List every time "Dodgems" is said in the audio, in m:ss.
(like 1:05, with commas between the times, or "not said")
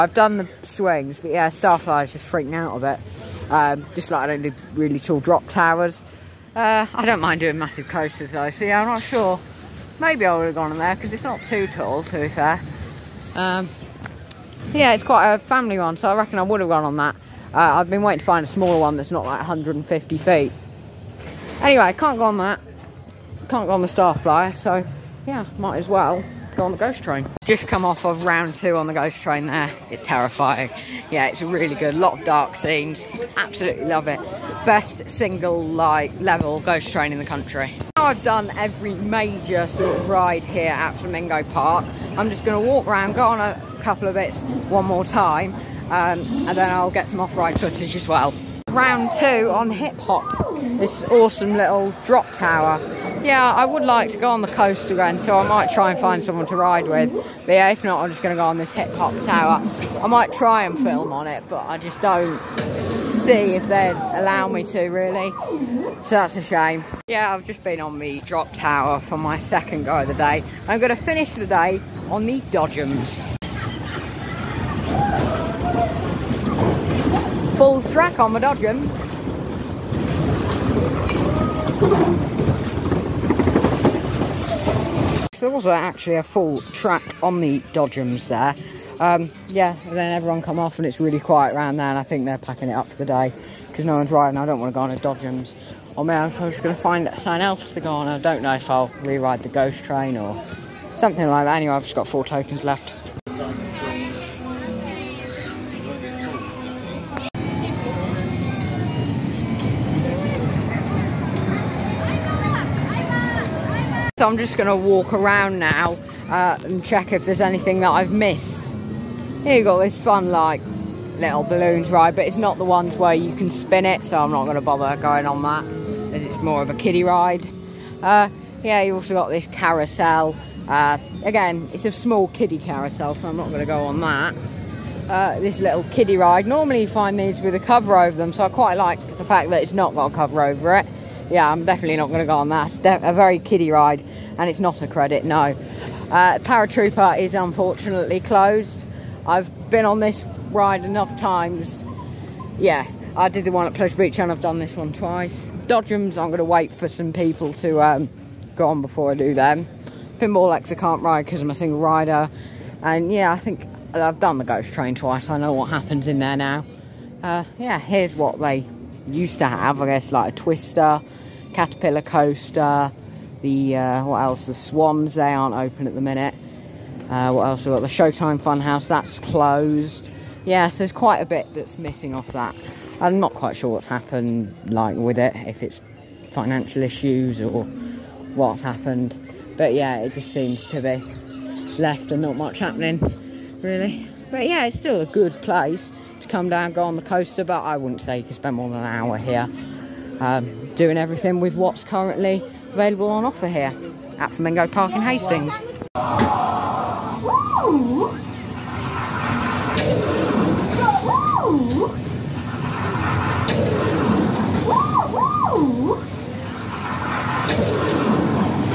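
1:12, 1:18, 1:27, 1:34, 2:35.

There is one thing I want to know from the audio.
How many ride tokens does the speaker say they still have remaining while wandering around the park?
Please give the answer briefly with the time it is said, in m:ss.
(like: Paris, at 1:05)
4, at 1:42.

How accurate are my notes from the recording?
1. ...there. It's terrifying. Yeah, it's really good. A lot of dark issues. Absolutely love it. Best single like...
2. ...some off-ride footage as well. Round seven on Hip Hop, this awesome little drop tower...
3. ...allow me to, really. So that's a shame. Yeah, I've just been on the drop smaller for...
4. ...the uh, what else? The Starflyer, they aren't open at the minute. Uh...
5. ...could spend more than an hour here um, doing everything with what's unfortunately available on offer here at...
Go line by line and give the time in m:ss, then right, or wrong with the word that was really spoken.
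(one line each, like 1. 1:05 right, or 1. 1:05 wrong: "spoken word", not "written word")
1. 0:29 wrong: "scenes", not "issues"
2. 0:47 wrong: "two", not "seven"
3. 1:03 wrong: "tower", not "smaller"
4. 2:53 wrong: "Swans", not "Starflyer"
5. 3:18 wrong: "currently", not "unfortunately".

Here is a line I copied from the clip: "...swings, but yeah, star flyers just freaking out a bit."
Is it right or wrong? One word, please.
right.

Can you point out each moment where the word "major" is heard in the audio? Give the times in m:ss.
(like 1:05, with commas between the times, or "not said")
0:38.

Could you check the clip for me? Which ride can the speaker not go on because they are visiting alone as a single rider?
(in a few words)
Pinball X.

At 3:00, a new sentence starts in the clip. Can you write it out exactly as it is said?
Yes, there's quite a bit that's missing off that.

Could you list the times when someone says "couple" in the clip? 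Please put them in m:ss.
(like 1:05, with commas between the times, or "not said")
0:43.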